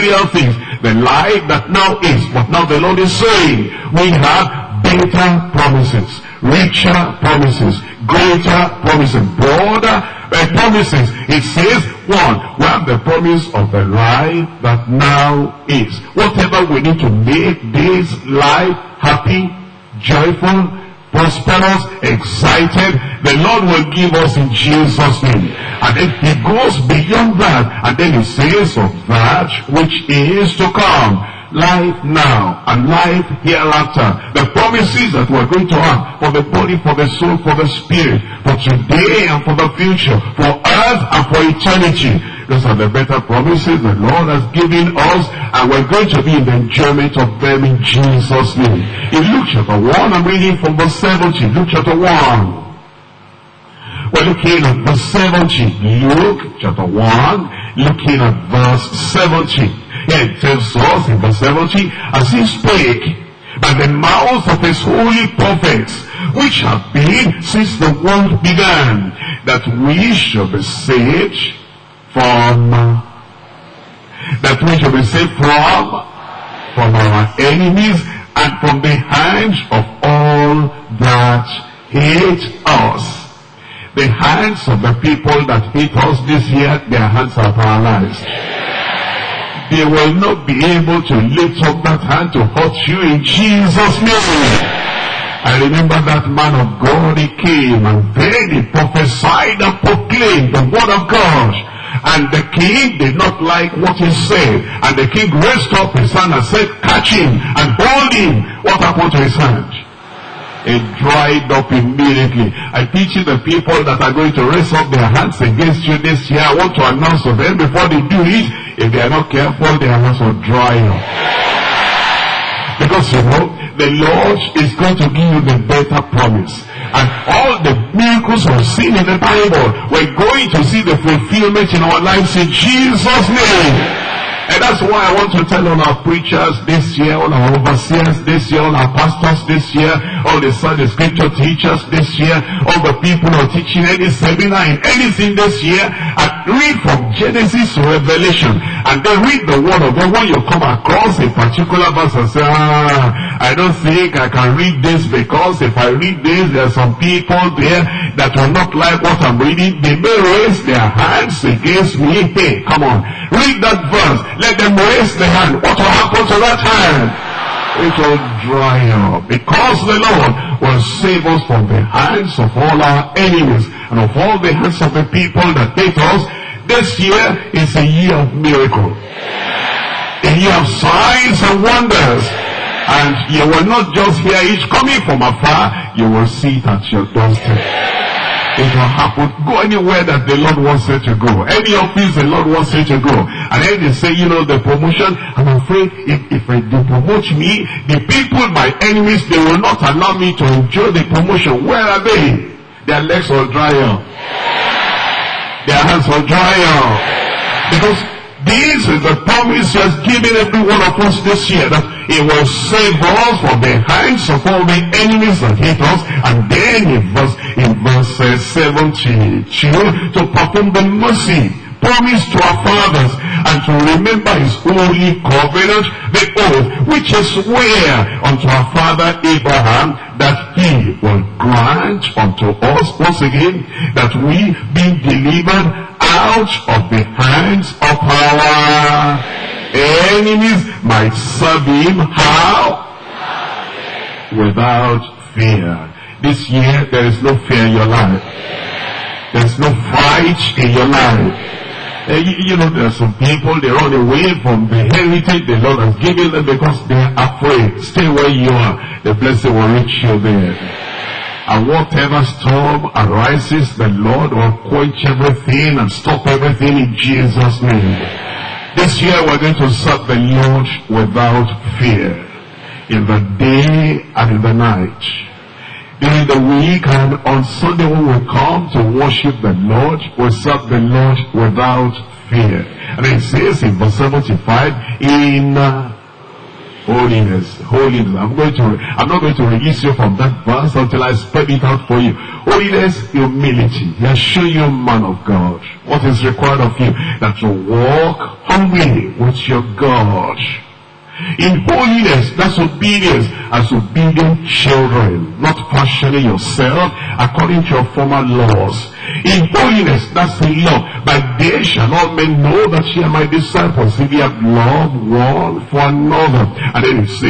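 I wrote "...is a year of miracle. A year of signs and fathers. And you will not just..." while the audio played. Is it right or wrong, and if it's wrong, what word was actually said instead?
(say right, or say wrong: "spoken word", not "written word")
wrong: "wonders", not "fathers".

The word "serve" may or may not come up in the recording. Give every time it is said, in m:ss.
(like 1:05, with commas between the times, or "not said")
4:01, 4:29, 4:40.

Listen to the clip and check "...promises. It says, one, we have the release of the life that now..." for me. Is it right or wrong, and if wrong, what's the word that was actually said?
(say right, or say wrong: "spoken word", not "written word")
wrong: "promise", not "release".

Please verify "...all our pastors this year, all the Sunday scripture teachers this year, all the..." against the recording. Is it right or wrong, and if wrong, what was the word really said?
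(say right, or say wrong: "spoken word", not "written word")
right.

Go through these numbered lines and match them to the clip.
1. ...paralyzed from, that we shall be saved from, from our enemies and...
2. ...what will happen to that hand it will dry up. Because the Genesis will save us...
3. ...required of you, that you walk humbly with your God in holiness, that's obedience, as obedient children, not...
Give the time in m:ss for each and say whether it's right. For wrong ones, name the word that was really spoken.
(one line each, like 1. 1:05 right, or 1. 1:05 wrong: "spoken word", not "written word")
1. 1:10 wrong: "saved", not "paralyzed"
2. 2:45 wrong: "Lord", not "Genesis"
3. 4:56 right.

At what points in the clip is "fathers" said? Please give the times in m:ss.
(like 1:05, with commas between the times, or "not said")
3:42, 3:48.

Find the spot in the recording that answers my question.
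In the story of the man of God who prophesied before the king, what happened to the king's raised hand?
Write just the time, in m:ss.
1:50.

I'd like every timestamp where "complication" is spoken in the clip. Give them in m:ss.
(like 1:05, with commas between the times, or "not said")
not said.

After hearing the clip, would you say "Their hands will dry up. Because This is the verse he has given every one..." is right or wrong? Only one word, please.
wrong.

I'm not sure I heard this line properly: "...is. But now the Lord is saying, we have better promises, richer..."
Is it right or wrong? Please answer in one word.
right.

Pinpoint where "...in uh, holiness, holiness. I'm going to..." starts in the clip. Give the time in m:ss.
4:45.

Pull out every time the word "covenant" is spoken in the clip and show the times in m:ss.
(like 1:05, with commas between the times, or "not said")
3:45.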